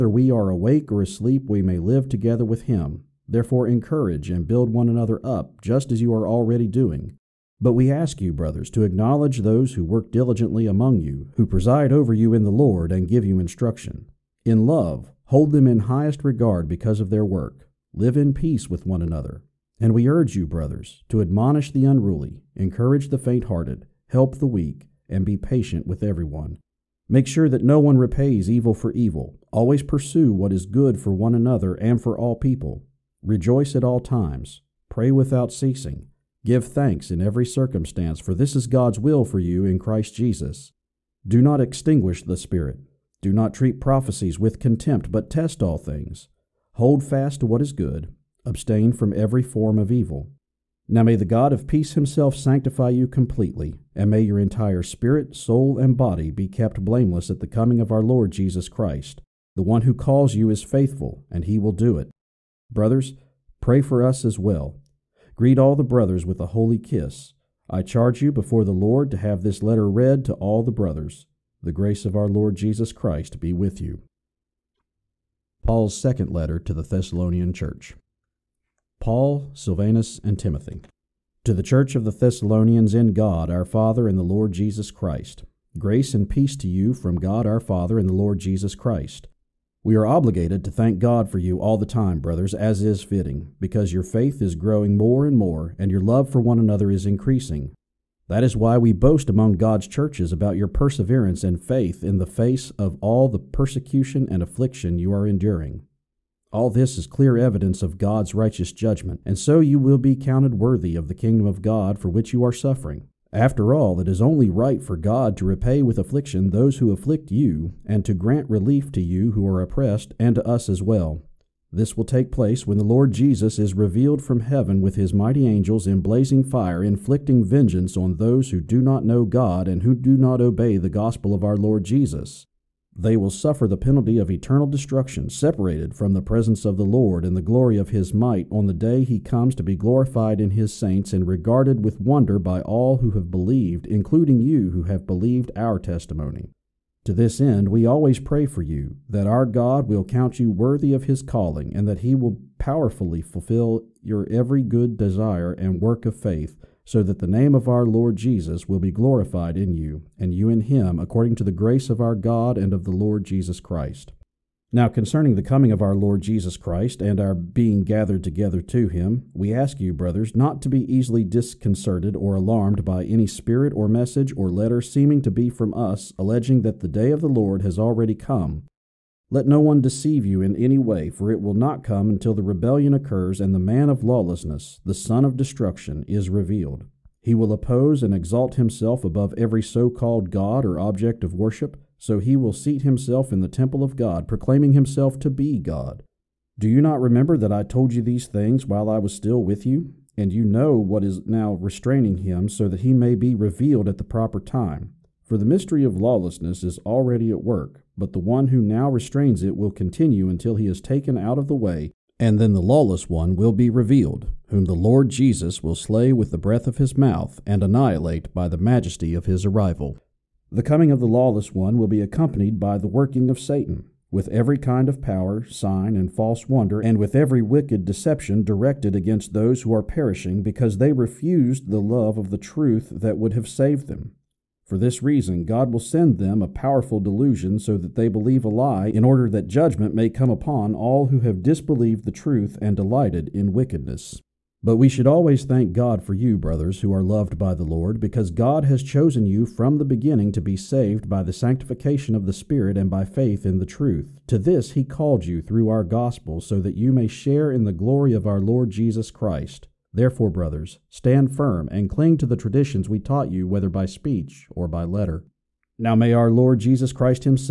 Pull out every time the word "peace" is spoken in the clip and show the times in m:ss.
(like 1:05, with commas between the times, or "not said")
0:18, 0:51, 1:26.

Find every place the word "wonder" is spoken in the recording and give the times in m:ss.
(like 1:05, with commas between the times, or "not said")
2:22, 3:46.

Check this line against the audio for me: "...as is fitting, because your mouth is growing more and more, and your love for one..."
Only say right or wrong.
wrong.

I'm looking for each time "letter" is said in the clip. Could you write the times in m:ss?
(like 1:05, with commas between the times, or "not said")
1:09, 1:16, 2:54, 4:24.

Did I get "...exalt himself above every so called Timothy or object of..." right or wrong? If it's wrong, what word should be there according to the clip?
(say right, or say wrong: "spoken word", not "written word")
wrong: "God", not "Timothy".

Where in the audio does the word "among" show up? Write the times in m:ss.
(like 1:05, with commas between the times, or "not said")
0:10, 1:39.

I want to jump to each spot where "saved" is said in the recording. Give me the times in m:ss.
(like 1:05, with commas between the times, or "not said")
3:53, 4:10.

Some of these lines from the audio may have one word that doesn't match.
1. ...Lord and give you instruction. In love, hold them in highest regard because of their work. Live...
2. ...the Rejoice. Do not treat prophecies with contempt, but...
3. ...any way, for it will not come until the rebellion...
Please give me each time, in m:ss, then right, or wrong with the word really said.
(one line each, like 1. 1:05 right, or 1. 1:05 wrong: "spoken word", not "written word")
1. 0:12 right
2. 0:42 wrong: "Spirit", not "Rejoice"
3. 3:00 right.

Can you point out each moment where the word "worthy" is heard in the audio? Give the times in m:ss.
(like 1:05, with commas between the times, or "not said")
1:50, 2:30.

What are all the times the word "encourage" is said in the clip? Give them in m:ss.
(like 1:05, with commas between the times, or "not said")
0:03, 0:22.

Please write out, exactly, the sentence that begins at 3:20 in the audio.
And you know what is now restraining him, so that he may be revealed at the proper time.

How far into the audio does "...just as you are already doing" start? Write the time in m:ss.
0:05.